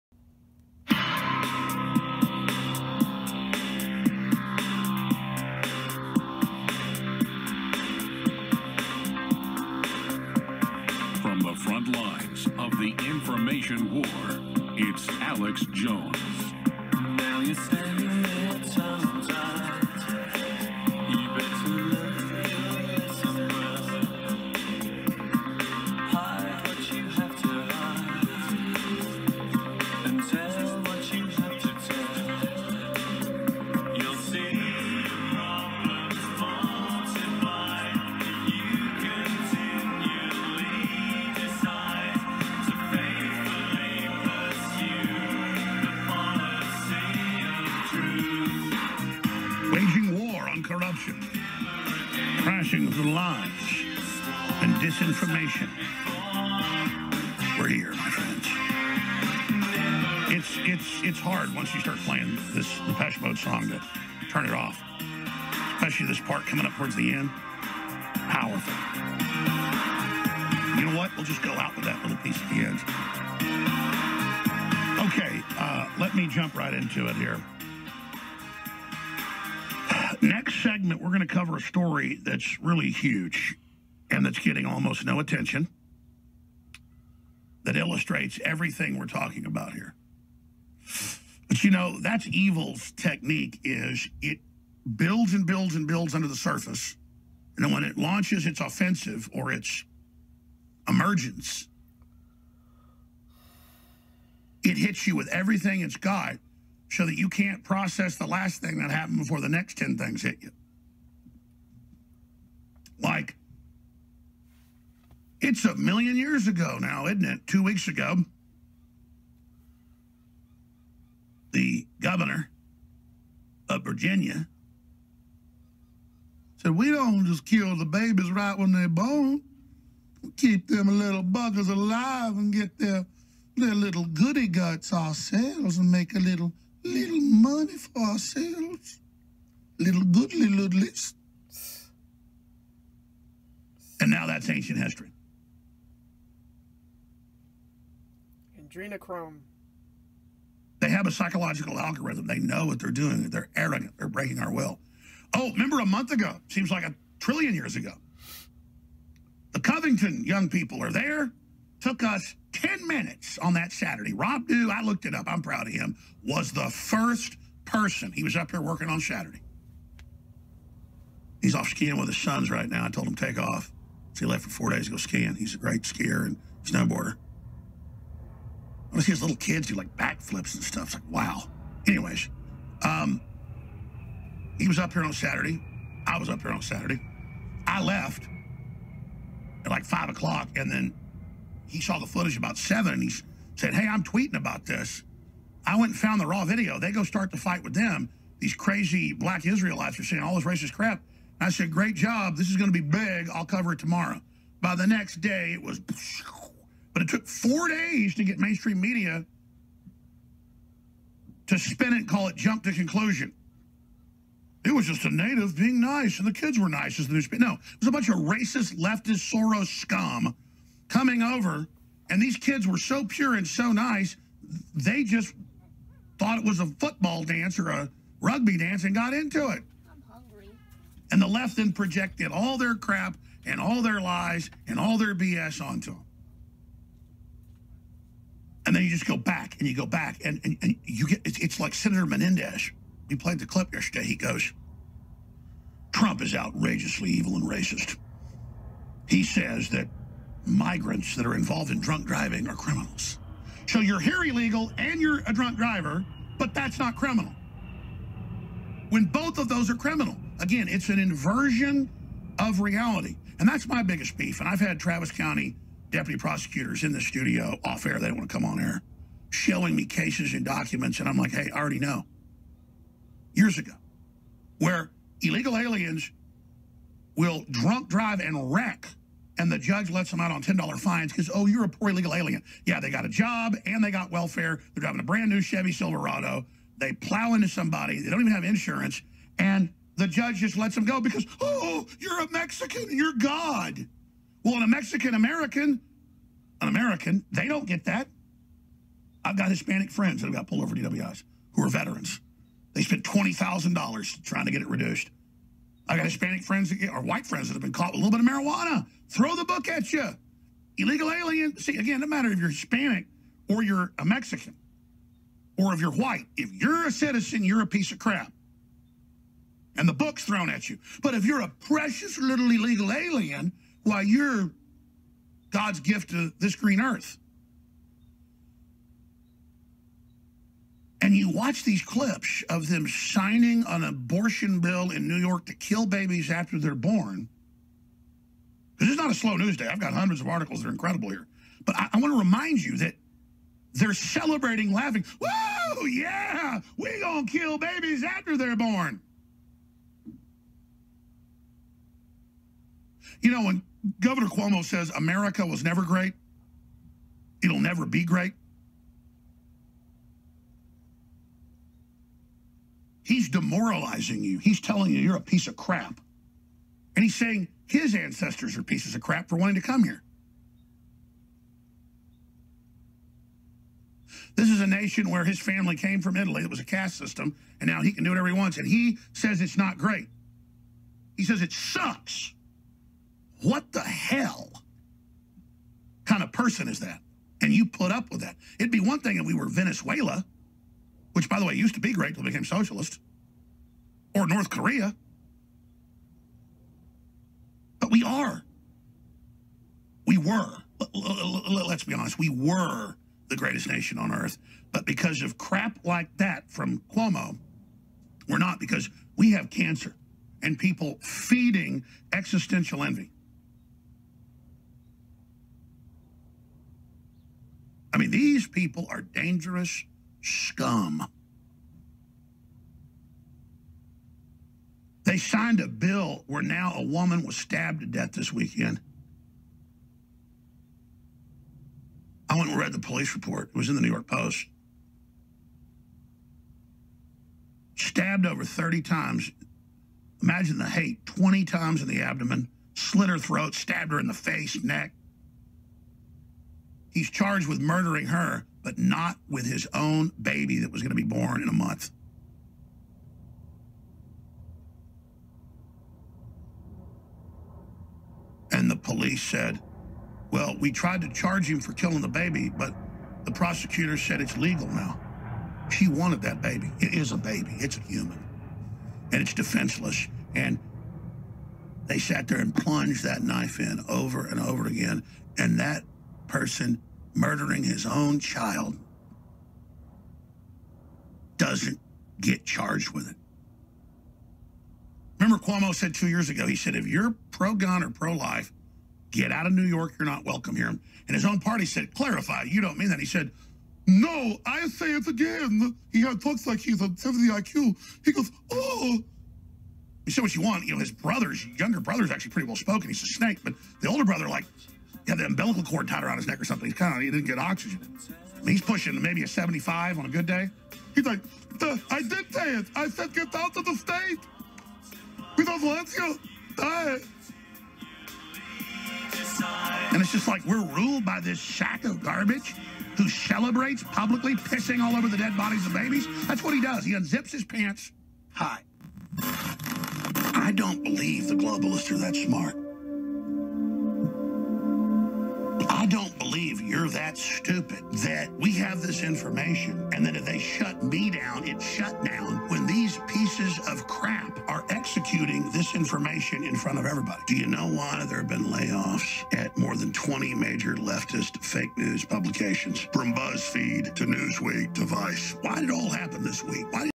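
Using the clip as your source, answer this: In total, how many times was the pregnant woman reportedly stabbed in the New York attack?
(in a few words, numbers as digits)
Over 30.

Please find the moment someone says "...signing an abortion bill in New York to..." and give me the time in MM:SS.
05:32.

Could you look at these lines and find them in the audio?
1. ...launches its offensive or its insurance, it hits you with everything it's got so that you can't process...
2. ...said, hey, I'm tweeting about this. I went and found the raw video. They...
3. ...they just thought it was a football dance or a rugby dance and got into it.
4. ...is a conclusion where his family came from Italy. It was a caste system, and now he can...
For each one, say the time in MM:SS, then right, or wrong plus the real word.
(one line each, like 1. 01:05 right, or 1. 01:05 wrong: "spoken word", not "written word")
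1. 01:37 wrong: "emergence", not "insurance"
2. 03:13 right
3. 03:44 right
4. 06:14 wrong: "nation", not "conclusion".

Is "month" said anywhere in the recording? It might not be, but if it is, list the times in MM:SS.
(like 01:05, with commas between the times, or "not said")
02:35, 07:31.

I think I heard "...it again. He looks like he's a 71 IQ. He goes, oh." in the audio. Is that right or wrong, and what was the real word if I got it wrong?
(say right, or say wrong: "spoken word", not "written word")
wrong: "70", not "71".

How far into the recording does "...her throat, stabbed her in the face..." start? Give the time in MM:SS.
07:23.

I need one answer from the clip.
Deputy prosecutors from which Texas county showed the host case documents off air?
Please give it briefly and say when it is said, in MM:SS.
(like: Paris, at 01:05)
Travis County, at 04:24.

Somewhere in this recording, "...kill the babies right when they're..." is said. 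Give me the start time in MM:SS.
02:07.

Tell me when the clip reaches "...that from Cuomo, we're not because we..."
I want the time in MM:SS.
06:46.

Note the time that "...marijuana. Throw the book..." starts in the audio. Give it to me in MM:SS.
05:08.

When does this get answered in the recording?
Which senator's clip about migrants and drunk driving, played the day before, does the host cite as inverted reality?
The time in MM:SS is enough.
04:02.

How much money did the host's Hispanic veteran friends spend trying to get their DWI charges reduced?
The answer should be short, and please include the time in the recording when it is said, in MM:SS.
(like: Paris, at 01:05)
$20,000, at 05:03.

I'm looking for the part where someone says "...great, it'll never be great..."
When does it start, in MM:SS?
05:55.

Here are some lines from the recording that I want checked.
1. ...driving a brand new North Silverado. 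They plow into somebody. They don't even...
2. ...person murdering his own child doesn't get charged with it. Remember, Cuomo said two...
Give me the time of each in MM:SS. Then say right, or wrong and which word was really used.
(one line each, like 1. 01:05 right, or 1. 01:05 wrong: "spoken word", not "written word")
1. 04:44 wrong: "Chevy", not "North"
2. 07:56 right.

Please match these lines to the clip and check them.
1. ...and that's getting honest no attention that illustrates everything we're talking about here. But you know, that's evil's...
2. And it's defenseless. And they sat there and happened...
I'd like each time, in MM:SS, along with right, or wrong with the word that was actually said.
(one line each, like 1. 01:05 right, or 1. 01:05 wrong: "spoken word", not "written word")
1. 01:24 wrong: "almost", not "honest"
2. 07:49 wrong: "plunged", not "happened".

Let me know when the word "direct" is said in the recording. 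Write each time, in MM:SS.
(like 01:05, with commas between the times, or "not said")
not said.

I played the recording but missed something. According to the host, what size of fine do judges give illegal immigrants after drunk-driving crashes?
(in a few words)
$10.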